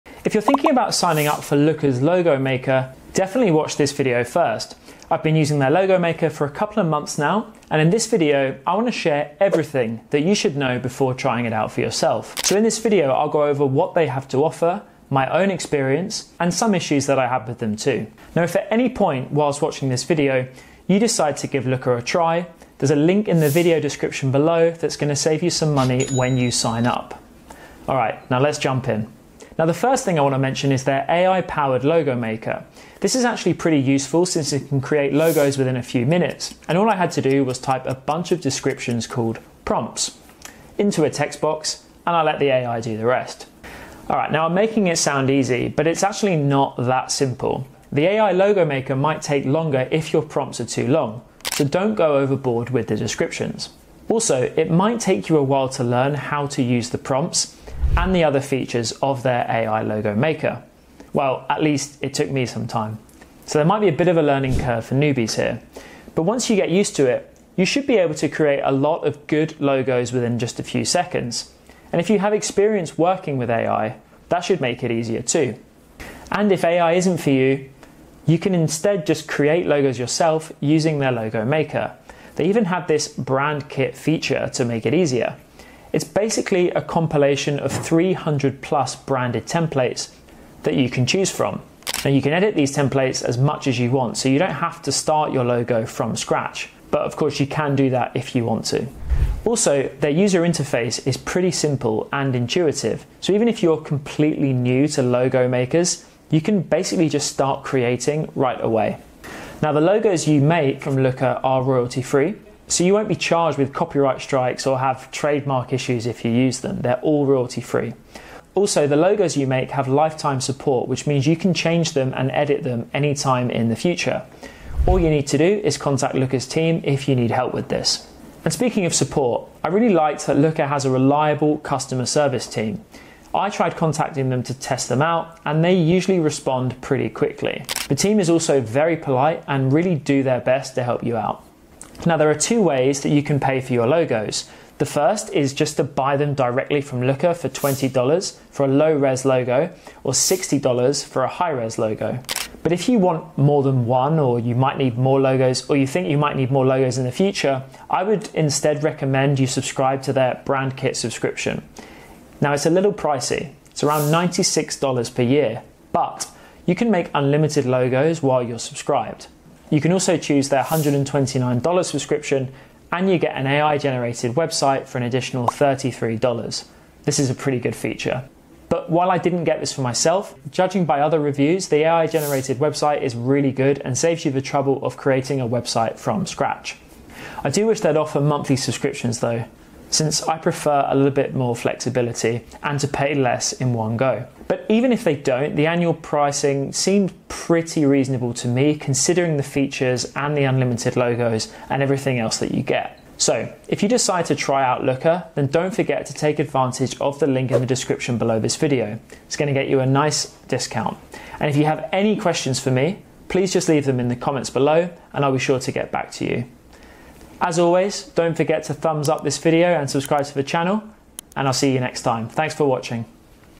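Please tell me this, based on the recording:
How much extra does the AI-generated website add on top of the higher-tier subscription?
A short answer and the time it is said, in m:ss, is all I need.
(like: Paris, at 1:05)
$33, at 2:55.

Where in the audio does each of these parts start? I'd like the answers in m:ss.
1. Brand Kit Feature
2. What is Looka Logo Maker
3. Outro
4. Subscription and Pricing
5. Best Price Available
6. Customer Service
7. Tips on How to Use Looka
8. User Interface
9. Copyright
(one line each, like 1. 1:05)
1. 1:21
2. 0:29
3. 3:24
4. 2:42
5. 0:18
6. 2:08
7. 0:46
8. 1:39
9. 1:49.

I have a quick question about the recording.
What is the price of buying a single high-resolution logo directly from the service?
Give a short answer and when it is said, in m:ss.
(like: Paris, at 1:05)
$60, at 2:30.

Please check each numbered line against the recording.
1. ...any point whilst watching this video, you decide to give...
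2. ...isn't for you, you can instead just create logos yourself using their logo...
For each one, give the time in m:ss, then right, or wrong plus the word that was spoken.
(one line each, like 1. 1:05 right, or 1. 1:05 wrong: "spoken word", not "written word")
1. 0:18 right
2. 1:16 right.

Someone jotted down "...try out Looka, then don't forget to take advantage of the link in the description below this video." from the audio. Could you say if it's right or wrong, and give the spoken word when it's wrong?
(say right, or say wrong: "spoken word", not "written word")
right.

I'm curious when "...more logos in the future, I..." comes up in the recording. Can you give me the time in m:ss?
2:36.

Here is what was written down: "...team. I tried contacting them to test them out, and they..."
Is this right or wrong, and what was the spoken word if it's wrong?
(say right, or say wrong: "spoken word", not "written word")
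right.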